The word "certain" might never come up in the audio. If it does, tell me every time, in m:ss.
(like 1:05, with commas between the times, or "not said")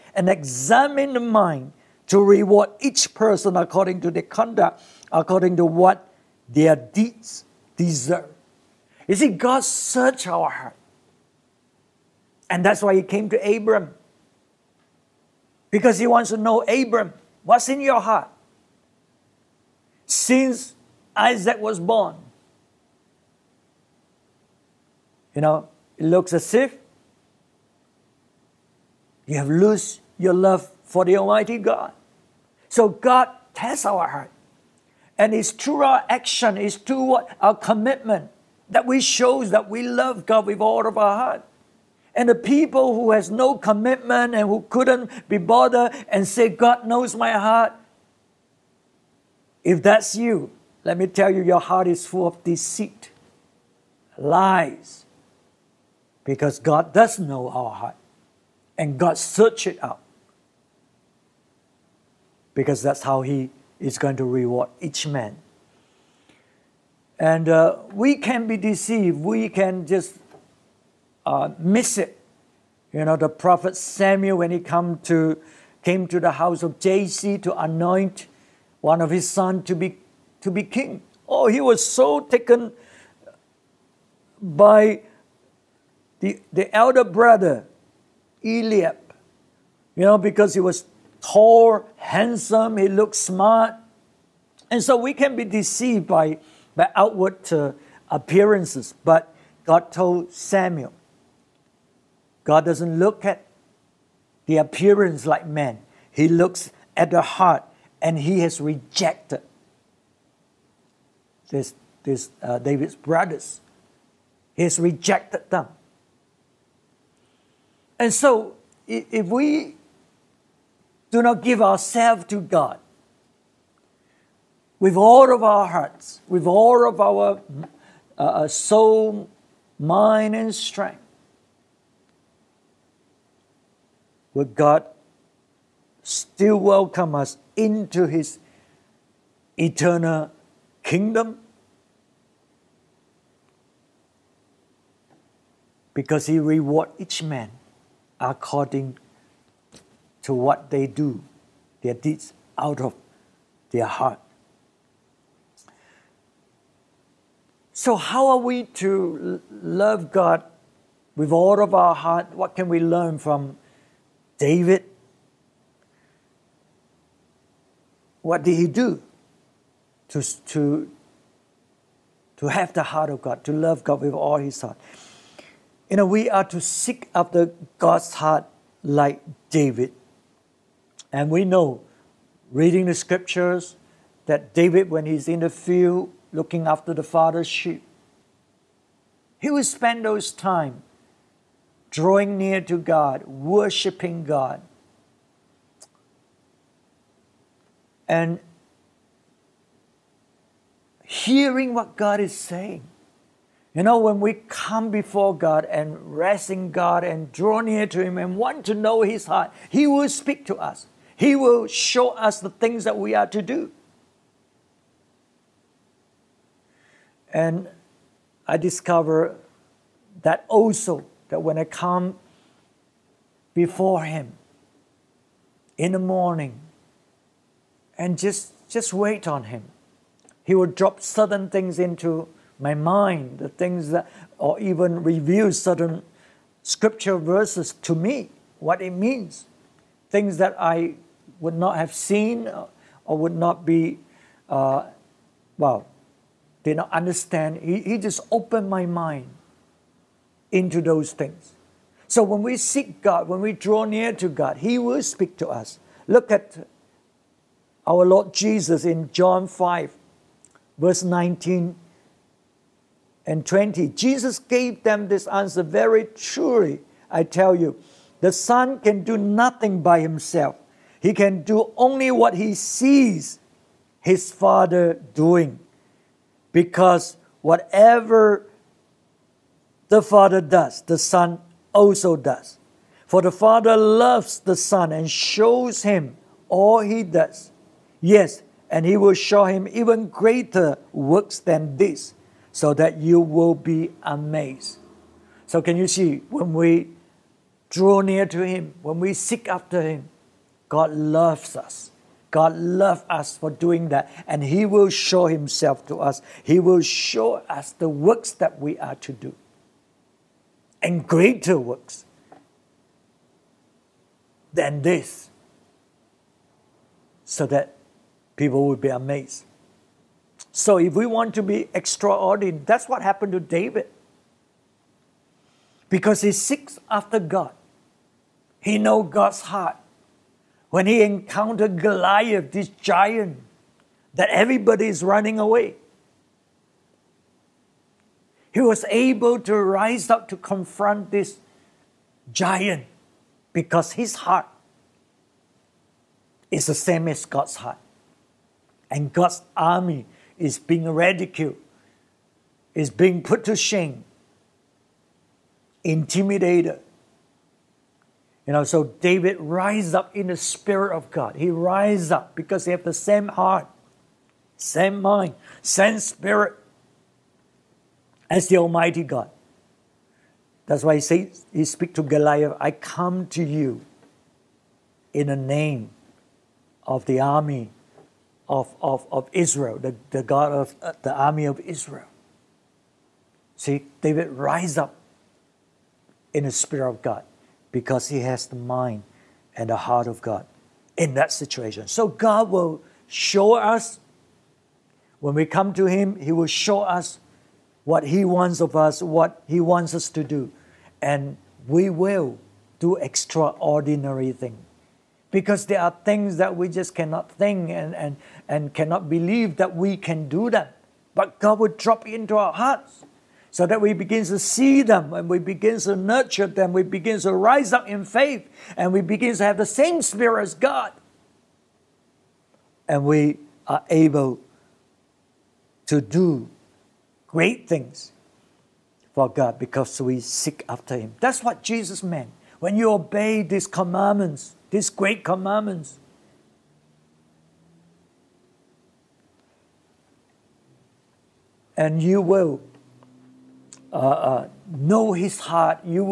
3:51, 3:55.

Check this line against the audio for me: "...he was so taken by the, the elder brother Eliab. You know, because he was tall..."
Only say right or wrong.
right.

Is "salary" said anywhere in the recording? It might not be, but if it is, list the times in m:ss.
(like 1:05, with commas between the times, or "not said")
not said.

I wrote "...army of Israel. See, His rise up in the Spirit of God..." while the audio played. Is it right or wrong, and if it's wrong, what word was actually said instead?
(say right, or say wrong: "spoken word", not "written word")
wrong: "David", not "His".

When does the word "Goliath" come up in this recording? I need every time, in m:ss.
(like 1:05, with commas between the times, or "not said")
5:31, 6:12.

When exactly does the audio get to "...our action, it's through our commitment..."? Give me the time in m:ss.
0:35.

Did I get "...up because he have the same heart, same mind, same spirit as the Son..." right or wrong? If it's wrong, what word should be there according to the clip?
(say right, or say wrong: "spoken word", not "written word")
wrong: "Almighty", not "Son".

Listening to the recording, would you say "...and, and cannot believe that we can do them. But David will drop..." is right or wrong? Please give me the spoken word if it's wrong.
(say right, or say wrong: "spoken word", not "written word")
wrong: "God", not "David".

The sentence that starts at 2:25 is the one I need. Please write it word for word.
Because He rewards each man according to what they do, their deeds out of their heart.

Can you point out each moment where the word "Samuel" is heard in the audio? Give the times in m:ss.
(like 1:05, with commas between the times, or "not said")
1:13, 1:40.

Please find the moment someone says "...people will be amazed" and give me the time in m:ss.
5:18.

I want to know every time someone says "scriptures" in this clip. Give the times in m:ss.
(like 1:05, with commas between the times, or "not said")
3:02, 3:56.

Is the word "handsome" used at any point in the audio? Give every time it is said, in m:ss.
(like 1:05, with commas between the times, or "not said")
1:31.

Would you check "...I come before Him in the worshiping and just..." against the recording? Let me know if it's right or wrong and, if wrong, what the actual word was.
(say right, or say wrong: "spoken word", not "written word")
wrong: "morning", not "worshiping".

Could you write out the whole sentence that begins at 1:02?
Because that's how He is going to reward each man.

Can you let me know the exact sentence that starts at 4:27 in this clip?
I tell you, the Son can do nothing by himself, he can do only what he sees his Father doing.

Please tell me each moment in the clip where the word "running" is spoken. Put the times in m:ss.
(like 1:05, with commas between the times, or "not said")
5:35.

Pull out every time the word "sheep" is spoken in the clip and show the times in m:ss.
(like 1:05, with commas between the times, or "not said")
3:07.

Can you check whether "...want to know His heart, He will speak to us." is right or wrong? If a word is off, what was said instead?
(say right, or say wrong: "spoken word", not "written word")
right.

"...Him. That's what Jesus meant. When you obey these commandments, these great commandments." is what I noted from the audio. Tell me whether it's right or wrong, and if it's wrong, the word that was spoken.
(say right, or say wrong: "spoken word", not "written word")
right.